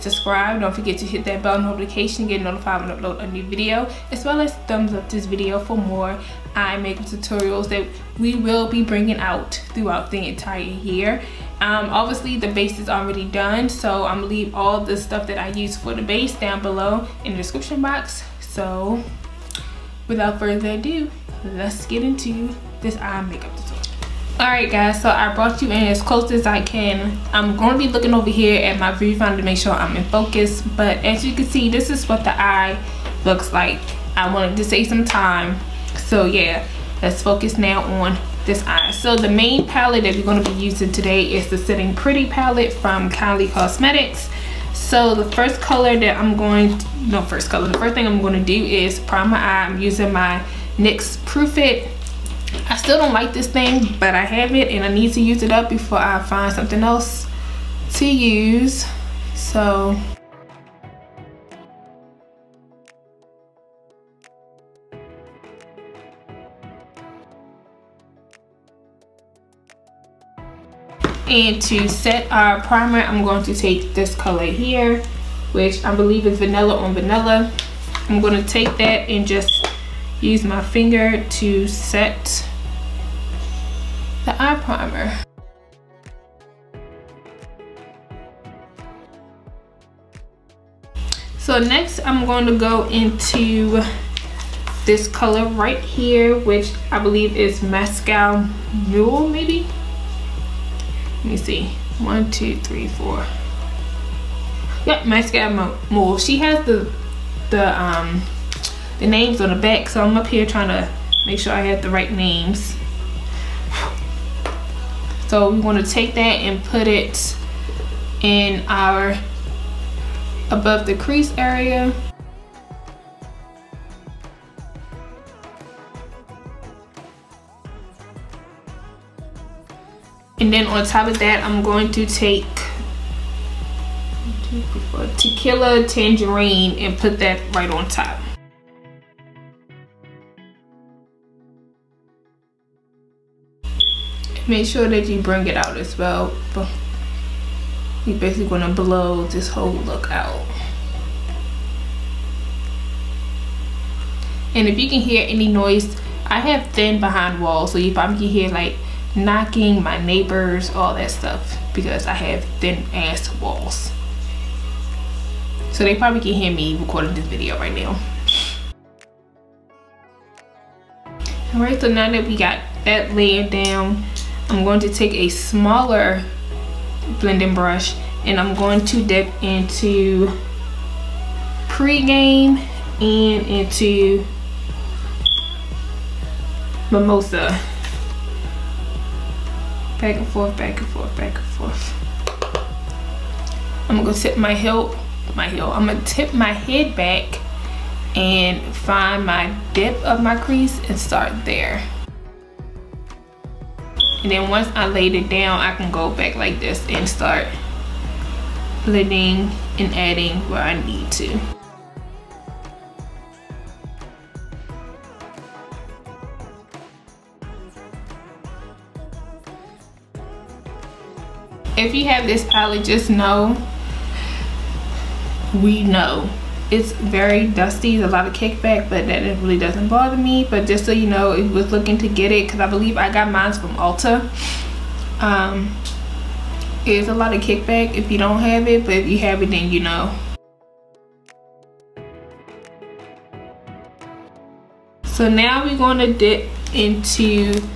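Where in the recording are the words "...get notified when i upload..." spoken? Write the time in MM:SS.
00:02.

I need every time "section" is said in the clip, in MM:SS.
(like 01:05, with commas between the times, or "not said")
not said.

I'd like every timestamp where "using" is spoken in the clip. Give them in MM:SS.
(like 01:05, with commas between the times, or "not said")
00:40, 00:49.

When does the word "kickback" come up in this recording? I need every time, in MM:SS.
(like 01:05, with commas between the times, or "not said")
03:48, 03:57.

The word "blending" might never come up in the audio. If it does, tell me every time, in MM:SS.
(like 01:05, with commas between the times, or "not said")
02:57, 03:28.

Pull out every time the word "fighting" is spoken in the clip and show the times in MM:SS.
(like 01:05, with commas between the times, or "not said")
not said.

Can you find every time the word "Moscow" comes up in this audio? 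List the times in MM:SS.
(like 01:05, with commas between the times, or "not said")
01:37, 01:45.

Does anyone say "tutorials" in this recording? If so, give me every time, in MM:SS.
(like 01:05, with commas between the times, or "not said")
00:07, 00:23.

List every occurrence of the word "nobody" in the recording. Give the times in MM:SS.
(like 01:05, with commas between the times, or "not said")
not said.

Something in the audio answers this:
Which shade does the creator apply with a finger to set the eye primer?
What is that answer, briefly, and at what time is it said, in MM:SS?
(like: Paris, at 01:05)
Vanilla on Vanilla, at 01:16.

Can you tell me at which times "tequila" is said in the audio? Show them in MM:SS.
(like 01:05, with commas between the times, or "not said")
02:15.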